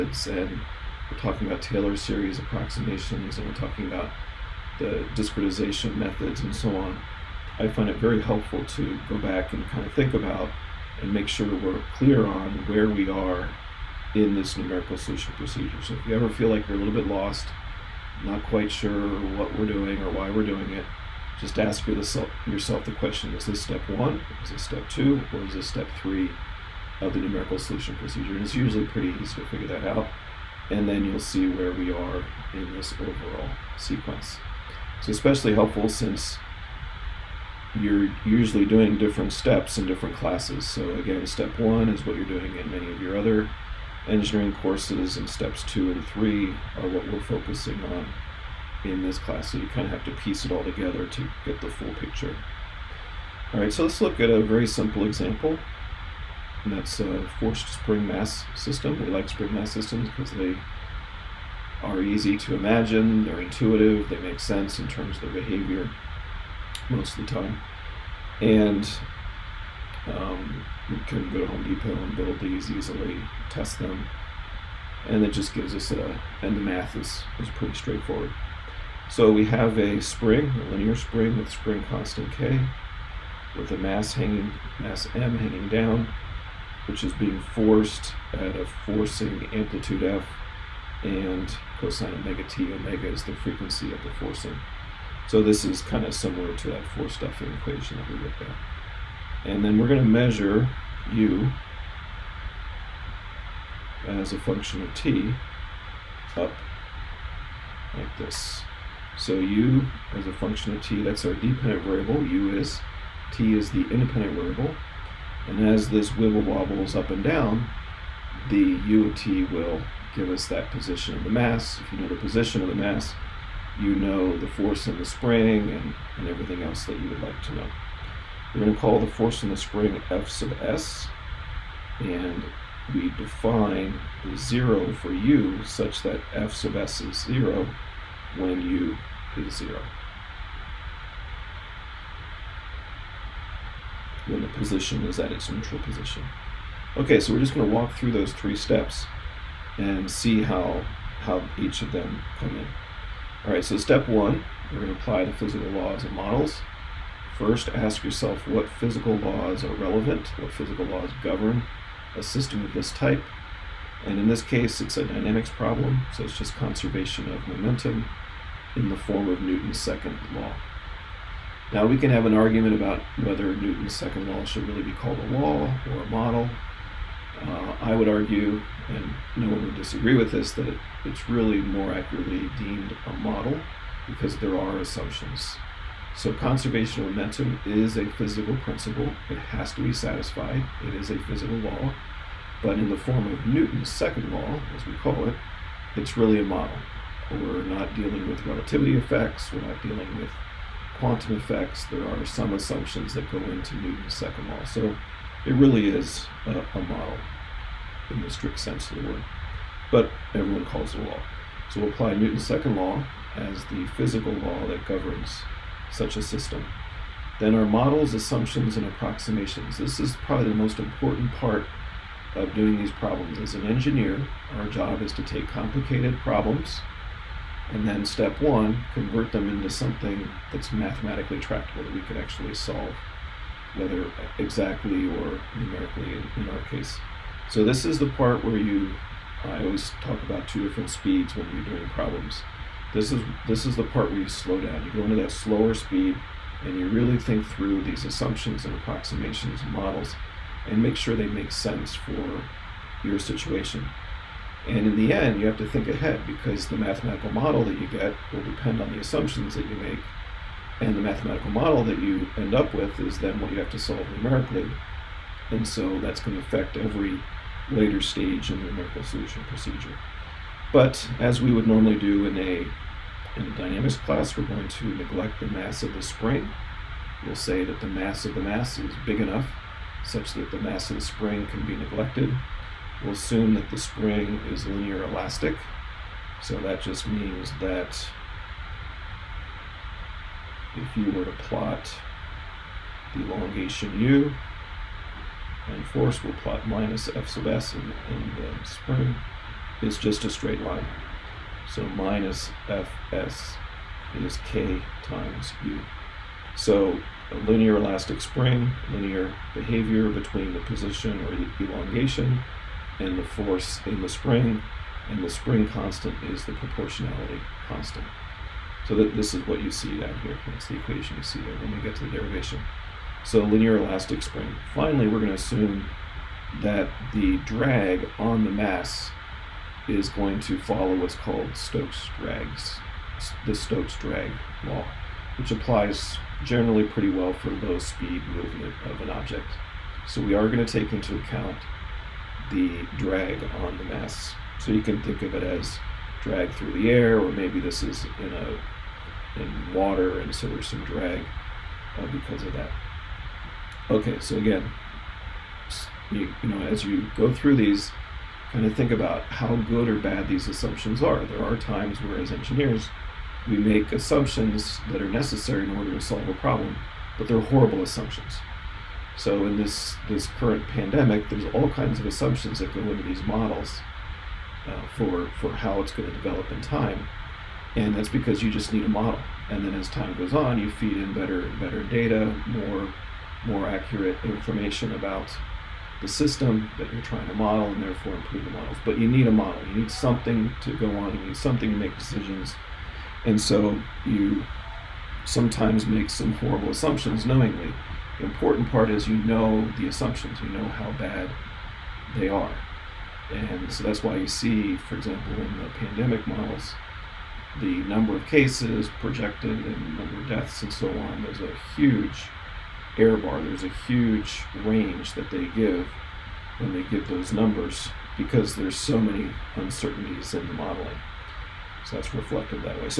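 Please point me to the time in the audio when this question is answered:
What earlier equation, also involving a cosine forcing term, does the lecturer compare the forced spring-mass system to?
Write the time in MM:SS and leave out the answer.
01:36.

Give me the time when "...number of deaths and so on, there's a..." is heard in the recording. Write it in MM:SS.
06:49.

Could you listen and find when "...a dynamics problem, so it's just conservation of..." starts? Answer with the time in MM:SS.
02:44.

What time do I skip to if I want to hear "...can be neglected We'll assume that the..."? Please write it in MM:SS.
04:41.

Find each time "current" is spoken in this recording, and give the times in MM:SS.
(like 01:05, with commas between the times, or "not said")
06:10.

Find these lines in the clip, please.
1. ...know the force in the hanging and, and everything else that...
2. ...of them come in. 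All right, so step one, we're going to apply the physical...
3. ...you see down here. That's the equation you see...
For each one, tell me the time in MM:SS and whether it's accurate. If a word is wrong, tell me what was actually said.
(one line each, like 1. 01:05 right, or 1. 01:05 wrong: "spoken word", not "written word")
1. 02:03 wrong: "spring", not "hanging"
2. 02:31 right
3. 05:19 right.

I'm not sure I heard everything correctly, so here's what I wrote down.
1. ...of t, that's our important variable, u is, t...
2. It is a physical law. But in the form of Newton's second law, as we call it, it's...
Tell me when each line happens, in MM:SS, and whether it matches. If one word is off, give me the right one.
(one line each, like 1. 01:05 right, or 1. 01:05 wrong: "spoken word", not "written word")
1. 01:50 wrong: "dependent", not "important"
2. 03:10 right.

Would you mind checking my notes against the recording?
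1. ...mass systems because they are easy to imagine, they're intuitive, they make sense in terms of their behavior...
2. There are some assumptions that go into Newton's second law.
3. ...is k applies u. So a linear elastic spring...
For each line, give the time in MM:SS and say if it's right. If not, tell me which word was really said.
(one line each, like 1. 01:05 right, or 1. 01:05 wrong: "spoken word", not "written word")
1. 00:59 right
2. 03:21 right
3. 05:04 wrong: "times", not "applies".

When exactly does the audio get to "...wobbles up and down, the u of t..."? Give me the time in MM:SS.
01:56.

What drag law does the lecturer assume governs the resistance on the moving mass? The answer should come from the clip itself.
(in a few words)
Stokes drag law.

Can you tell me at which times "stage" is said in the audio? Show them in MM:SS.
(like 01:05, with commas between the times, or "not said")
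04:28.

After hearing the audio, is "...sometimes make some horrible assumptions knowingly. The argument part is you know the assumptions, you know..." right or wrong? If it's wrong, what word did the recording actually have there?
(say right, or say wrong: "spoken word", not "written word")
wrong: "important", not "argument".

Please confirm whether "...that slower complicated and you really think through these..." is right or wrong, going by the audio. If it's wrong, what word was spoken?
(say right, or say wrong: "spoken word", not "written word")
wrong: "speed", not "complicated".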